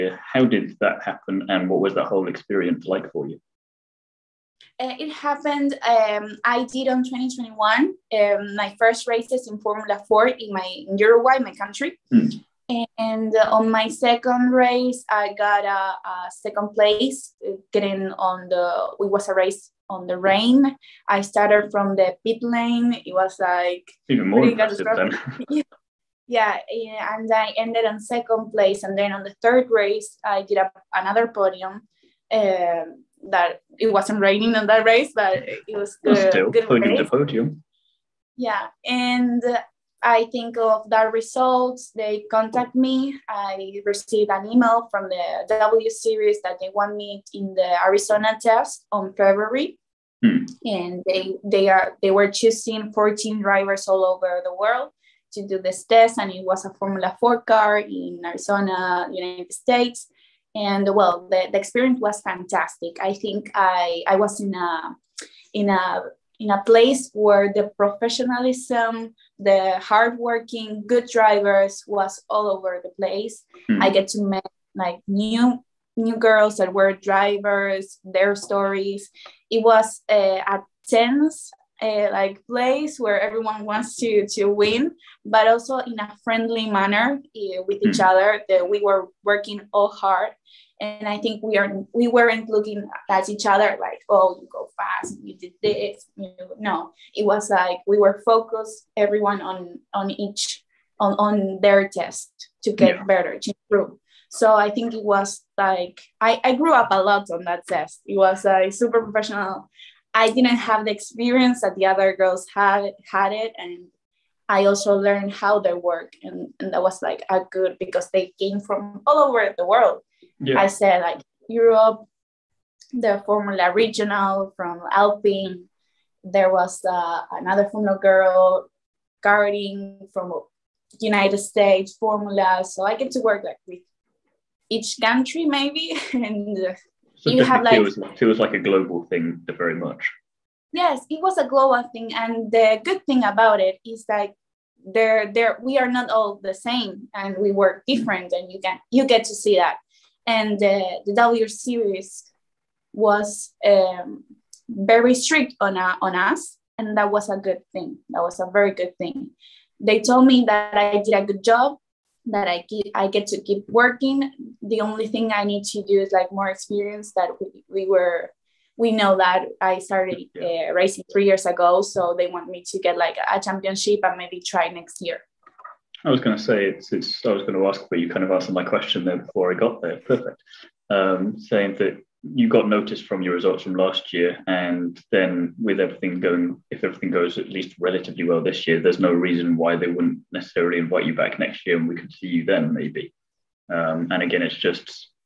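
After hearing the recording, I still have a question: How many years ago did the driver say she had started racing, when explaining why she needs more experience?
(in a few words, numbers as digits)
3 years.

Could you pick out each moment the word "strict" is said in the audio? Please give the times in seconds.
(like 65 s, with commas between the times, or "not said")
155 s.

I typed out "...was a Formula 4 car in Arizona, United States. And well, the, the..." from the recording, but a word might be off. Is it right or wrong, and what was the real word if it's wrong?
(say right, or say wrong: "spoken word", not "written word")
right.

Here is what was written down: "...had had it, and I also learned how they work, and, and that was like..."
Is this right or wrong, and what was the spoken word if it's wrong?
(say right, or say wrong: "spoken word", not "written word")
right.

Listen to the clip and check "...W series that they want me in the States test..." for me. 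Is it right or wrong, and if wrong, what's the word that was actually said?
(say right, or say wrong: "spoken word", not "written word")
wrong: "Arizona", not "States".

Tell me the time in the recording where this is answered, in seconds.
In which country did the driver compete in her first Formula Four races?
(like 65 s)
10 s.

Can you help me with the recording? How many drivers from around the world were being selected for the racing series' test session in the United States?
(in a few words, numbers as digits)
14.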